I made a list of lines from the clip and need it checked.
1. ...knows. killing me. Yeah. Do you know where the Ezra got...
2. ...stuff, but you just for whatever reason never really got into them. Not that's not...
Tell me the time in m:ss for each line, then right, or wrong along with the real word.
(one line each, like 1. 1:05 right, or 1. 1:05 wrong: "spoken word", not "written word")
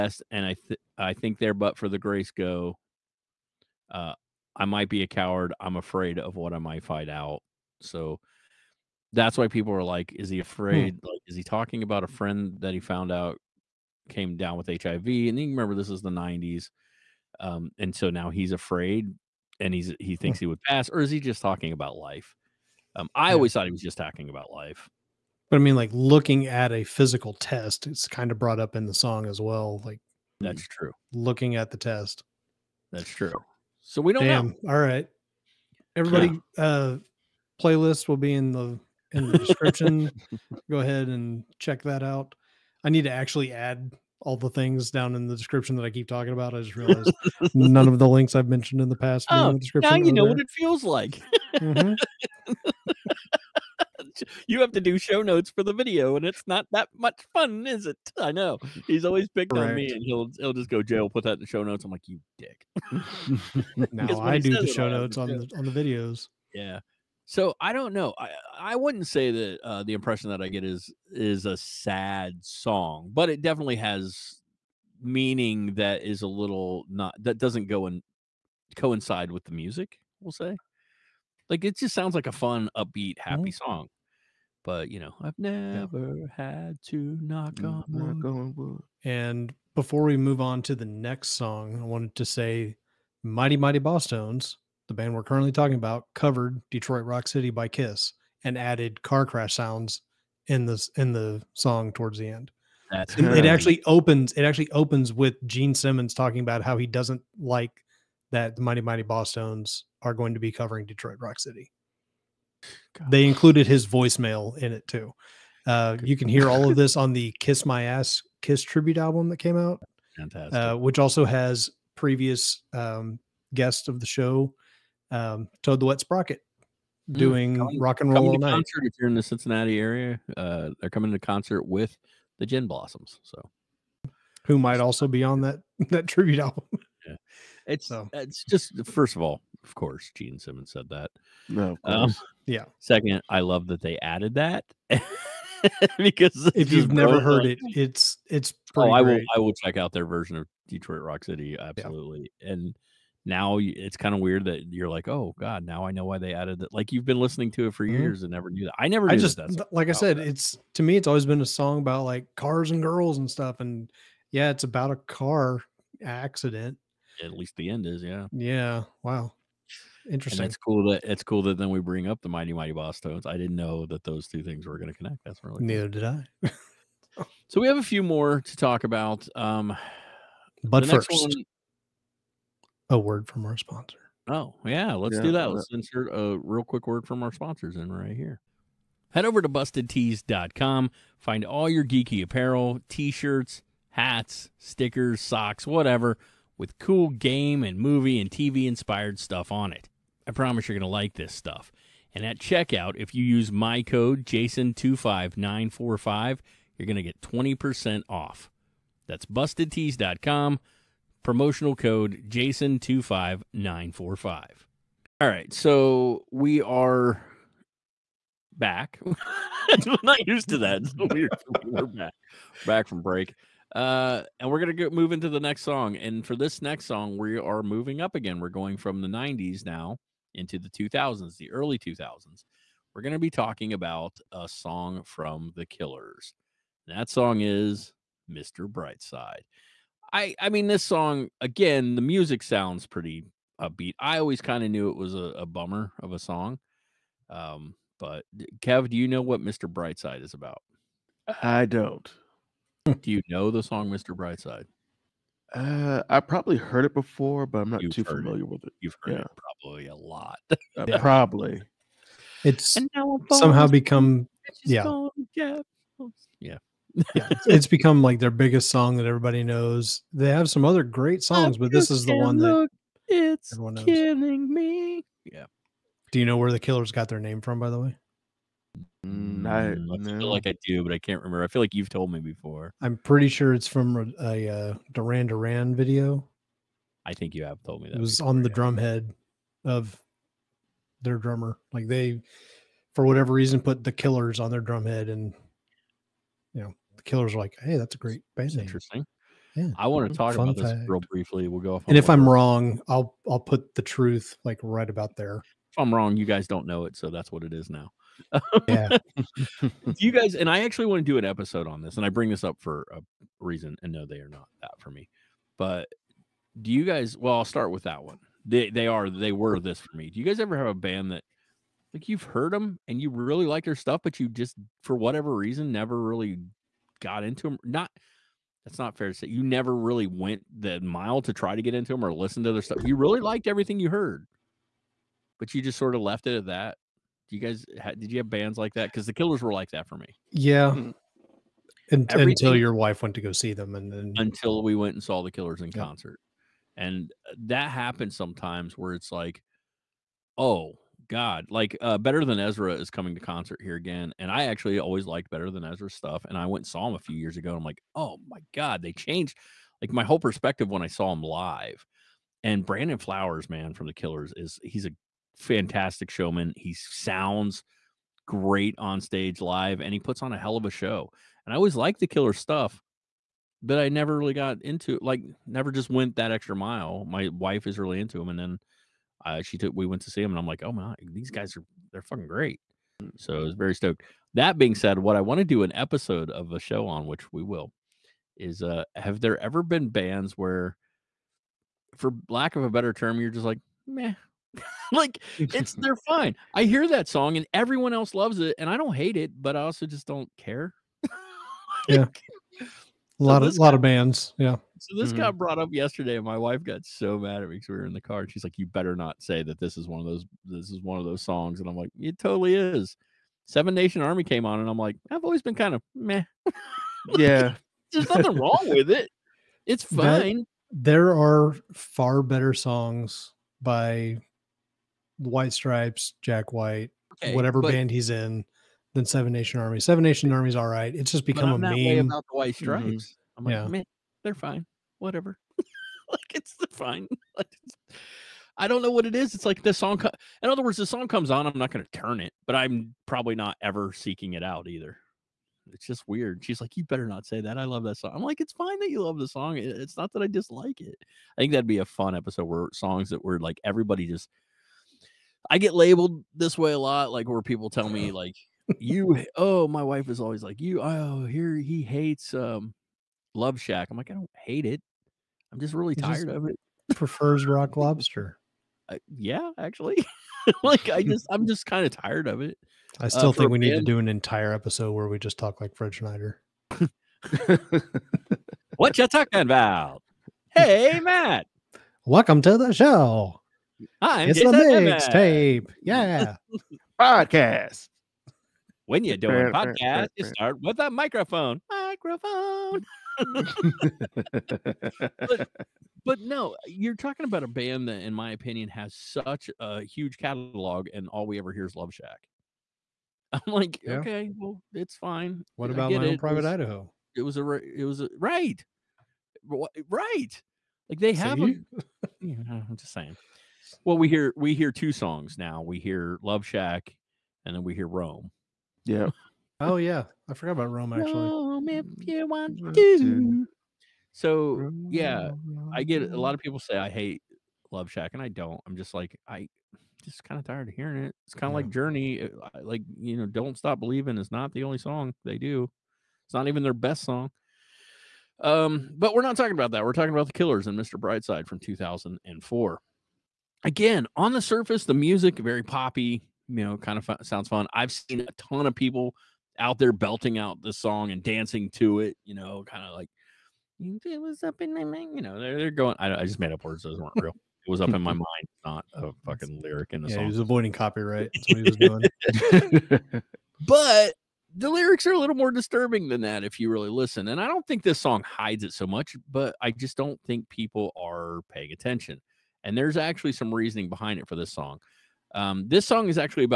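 1. 4:33 wrong: "Killers", not "Ezra"
2. 5:23 right.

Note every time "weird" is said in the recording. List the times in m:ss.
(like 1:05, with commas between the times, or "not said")
2:34, 7:26.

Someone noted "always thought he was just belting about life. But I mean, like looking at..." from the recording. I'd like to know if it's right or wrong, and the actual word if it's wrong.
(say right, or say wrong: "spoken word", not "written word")
wrong: "talking", not "belting".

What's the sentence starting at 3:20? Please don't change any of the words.
I promise you're going to like this stuff.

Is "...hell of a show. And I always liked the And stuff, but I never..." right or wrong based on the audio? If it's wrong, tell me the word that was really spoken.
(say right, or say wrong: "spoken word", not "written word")
wrong: "Killer", not "And".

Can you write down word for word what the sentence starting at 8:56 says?
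It's not even their best song.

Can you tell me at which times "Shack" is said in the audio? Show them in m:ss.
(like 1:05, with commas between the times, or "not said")
7:43, 8:21, 8:36, 8:47.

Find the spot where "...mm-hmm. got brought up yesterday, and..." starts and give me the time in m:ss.
6:45.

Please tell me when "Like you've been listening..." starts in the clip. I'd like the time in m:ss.
2:36.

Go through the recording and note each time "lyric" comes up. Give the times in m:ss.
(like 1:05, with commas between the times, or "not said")
9:19, 9:24.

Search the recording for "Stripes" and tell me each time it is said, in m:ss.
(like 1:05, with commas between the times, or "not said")
7:05, 7:12.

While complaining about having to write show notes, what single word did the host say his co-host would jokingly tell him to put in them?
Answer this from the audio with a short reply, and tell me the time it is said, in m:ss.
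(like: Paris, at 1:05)
jail, at 1:00.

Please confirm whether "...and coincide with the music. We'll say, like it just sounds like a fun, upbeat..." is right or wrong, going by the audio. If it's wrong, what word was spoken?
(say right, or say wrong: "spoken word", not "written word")
right.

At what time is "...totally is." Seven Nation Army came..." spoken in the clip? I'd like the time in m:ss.
6:52.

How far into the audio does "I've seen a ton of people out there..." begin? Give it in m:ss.
9:07.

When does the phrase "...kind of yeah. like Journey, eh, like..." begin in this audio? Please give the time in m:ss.
8:51.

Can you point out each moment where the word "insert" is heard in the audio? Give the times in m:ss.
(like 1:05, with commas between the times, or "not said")
3:05.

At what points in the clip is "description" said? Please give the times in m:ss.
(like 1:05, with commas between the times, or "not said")
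0:39, 0:45.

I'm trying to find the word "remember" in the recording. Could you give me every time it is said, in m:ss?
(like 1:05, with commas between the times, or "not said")
0:15, 4:41.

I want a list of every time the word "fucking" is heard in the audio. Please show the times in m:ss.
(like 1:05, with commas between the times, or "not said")
6:22, 9:19.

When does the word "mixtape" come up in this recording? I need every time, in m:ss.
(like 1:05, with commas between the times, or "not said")
8:04.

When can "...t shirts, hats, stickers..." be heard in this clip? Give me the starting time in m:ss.
3:12.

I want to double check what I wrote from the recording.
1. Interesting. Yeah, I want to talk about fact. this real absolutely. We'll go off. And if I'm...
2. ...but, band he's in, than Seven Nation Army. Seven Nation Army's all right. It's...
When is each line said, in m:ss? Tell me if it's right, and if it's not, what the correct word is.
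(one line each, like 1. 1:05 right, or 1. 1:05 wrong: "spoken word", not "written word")
1. 4:58 wrong: "briefly", not "absolutely"
2. 7:07 right.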